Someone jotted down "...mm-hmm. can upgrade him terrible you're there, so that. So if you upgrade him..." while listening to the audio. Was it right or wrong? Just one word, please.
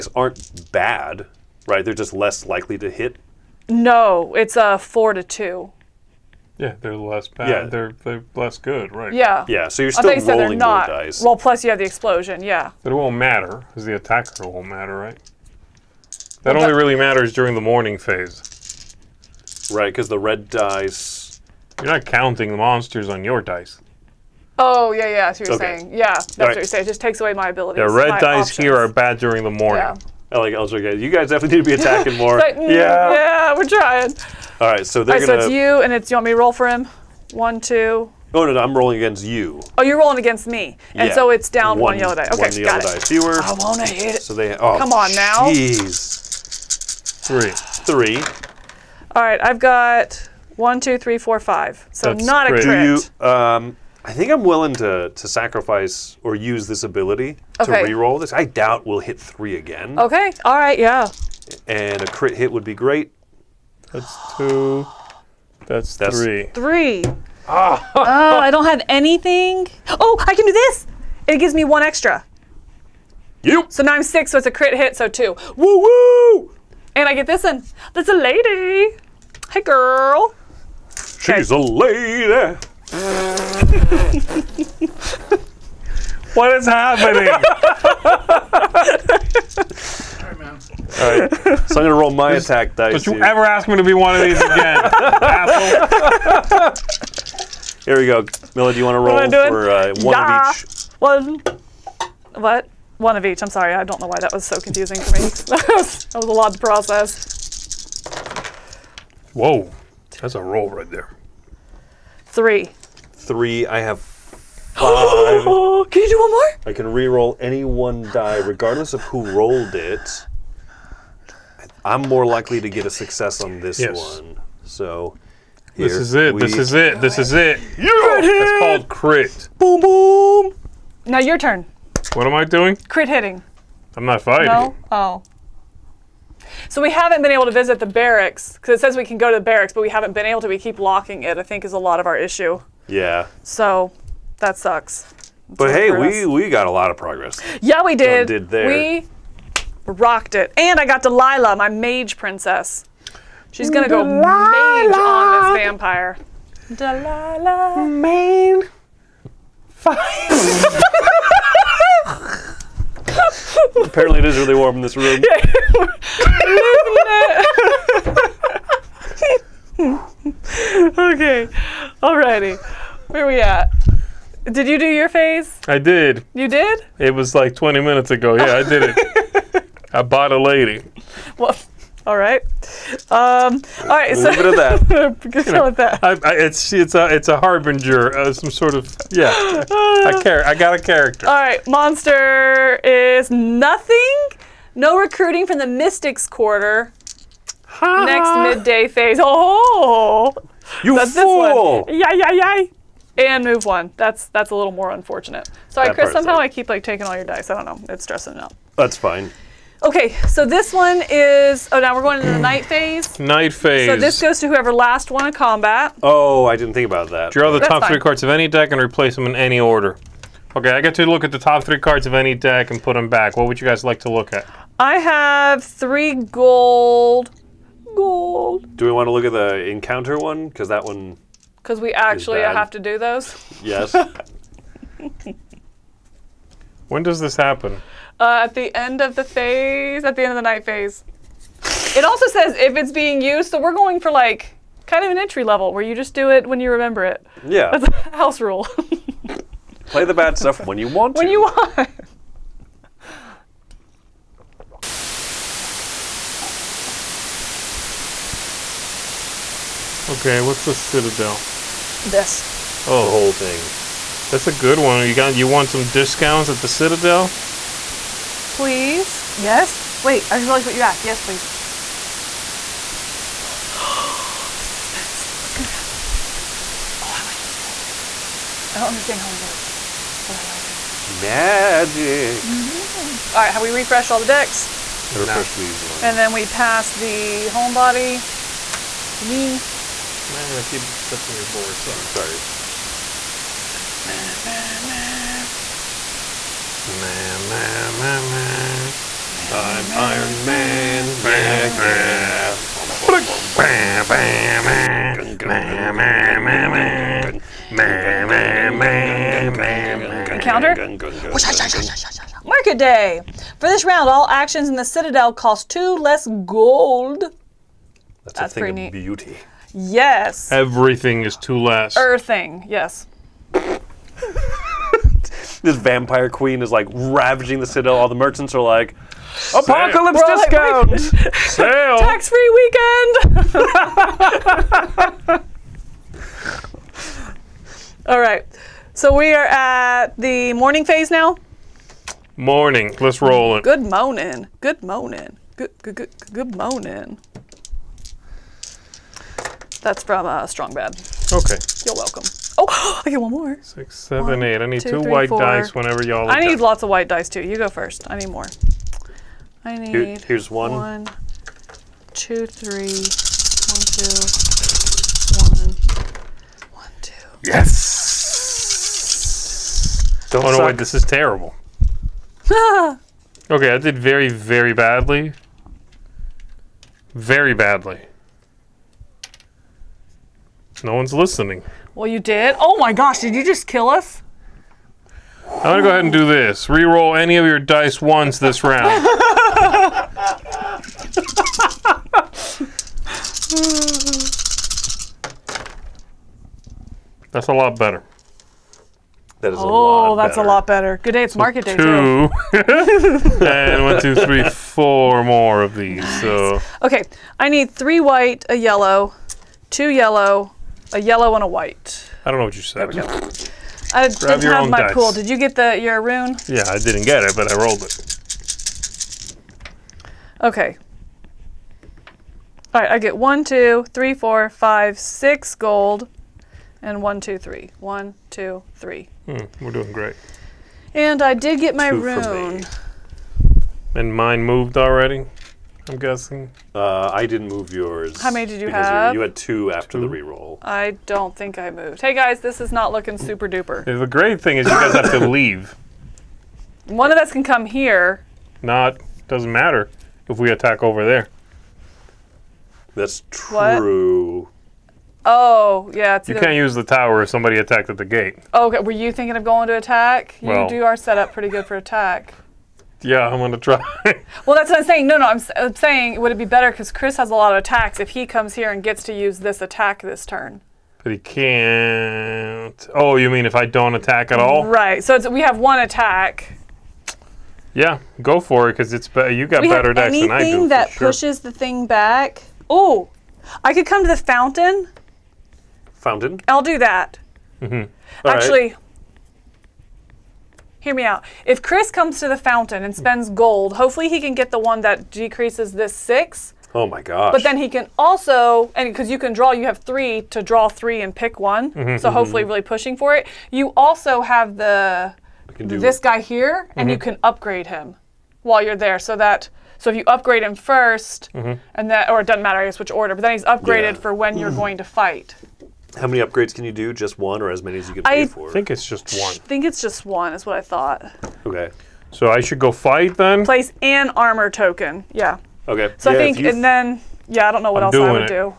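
wrong.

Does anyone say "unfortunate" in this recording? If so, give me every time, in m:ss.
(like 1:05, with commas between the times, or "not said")
3:24.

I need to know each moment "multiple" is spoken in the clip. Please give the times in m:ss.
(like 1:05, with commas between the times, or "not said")
not said.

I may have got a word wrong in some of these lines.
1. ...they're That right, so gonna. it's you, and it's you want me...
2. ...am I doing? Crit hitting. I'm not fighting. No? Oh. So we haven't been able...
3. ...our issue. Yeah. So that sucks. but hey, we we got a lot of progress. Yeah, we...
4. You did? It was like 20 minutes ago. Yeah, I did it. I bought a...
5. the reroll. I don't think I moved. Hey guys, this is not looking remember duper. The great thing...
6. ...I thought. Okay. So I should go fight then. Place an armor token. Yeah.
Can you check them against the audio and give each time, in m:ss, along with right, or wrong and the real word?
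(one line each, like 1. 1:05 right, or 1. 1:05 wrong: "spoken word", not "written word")
1. 0:35 wrong: "All", not "That"
2. 2:12 right
3. 2:22 right
4. 2:56 right
5. 7:20 wrong: "super", not "remember"
6. 8:40 right.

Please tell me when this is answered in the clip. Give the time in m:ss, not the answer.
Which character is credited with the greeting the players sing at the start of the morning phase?
5:50.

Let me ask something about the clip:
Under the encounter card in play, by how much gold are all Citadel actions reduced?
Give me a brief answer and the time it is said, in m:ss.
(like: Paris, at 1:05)
2, at 5:15.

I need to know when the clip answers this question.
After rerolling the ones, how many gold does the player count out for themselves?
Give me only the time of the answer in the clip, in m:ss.
7:04.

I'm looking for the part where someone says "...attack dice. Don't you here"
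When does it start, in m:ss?
1:32.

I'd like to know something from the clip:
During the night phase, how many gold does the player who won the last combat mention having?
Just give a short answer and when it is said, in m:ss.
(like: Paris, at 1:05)
3, at 3:44.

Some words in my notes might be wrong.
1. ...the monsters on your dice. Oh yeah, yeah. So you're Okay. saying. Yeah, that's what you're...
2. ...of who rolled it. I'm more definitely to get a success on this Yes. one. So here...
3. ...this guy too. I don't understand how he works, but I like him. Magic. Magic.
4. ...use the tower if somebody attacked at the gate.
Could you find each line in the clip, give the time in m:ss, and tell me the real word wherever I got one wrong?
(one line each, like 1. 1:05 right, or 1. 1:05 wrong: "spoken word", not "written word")
1. 0:22 right
2. 1:58 wrong: "likely", not "definitely"
3. 4:37 right
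4. 7:36 right.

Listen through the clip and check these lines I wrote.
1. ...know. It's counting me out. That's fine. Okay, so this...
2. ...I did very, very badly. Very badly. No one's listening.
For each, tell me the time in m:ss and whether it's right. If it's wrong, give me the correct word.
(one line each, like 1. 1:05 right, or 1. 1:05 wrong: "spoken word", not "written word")
1. 3:27 wrong: "stressing", not "counting"
2. 6:13 right.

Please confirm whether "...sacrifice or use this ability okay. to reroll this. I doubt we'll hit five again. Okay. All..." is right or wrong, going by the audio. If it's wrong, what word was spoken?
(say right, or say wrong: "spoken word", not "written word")
wrong: "three", not "five".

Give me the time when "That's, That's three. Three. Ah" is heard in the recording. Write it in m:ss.
1:05.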